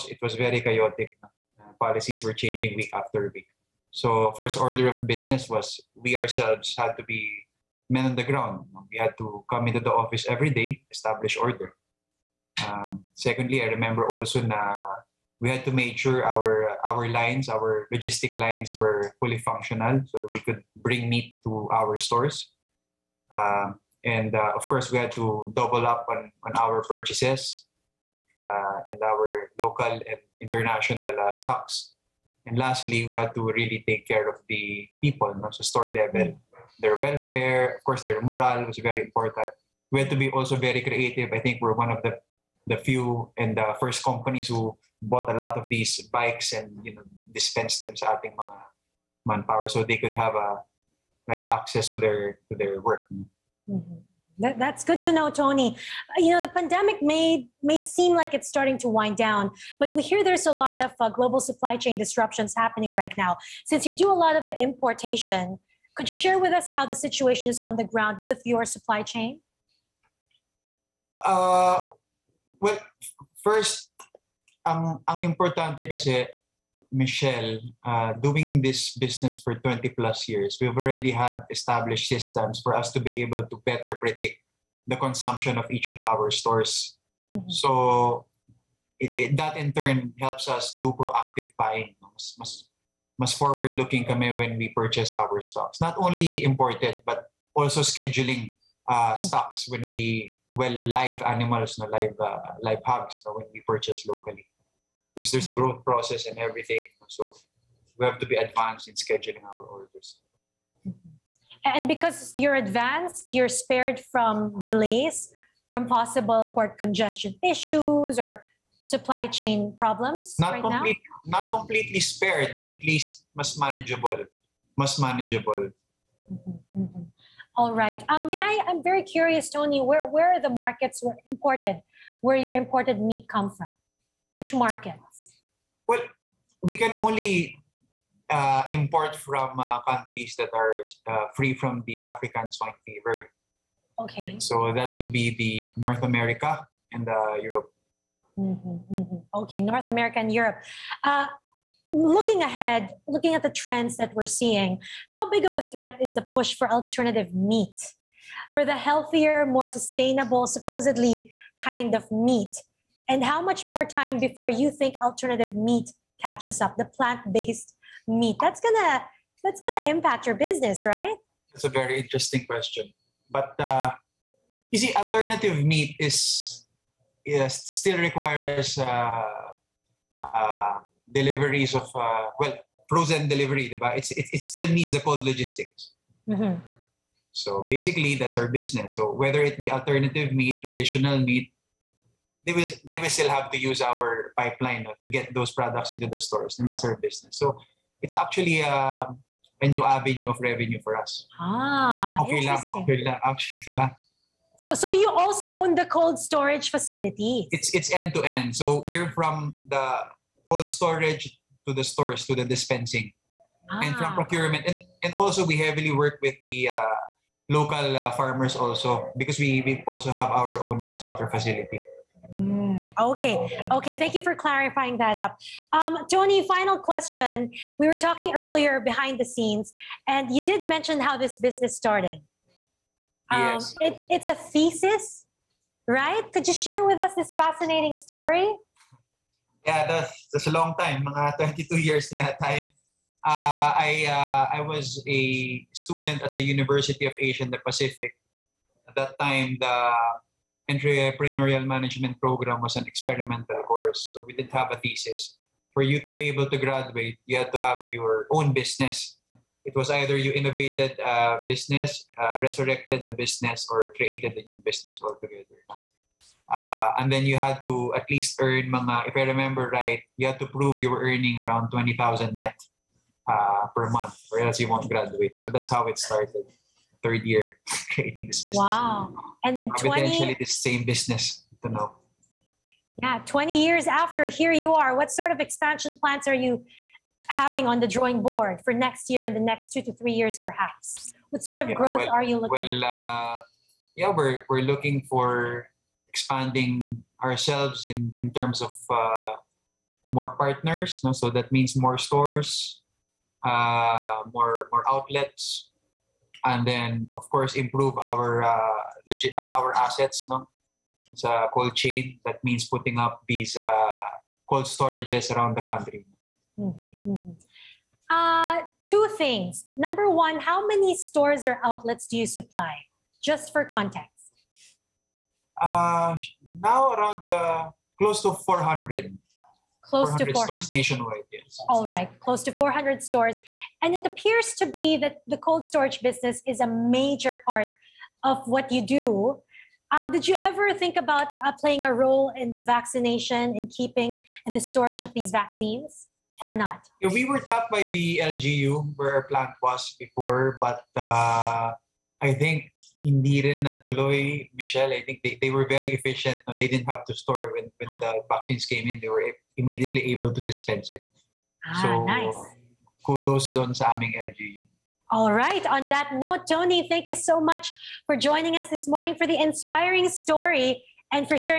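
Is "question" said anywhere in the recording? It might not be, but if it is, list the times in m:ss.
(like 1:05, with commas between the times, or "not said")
2:52, 3:46.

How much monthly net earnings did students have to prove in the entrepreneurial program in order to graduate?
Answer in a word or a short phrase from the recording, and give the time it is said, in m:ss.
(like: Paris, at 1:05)
20,000, at 4:31.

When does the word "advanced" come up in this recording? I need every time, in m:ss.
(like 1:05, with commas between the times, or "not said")
1:48, 1:52.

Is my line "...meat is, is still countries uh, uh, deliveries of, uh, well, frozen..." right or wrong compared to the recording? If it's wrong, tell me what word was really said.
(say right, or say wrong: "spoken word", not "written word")
wrong: "requires", not "countries".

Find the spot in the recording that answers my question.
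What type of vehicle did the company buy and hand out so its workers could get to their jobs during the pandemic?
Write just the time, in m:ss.
0:46.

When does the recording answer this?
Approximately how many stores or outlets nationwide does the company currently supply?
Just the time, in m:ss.
5:32.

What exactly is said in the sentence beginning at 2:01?
Not completely spared, but at least mas manageable.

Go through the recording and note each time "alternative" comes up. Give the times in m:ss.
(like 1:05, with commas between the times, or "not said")
2:36, 2:45, 2:54, 3:09.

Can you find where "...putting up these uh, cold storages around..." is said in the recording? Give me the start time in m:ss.
5:12.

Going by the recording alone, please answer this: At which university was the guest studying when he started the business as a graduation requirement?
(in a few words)
University of Asia and the Pacific.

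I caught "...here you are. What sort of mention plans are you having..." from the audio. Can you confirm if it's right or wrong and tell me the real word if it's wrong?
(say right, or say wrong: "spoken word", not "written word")
wrong: "expansion", not "mention".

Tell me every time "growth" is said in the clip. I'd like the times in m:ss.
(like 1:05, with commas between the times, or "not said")
1:45, 4:51.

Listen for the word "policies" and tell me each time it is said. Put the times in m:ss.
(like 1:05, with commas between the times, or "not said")
0:01.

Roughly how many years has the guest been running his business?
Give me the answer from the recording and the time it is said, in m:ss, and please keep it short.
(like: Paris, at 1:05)
20 plus years, at 1:19.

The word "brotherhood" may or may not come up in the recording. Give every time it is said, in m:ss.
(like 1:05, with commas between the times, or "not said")
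not said.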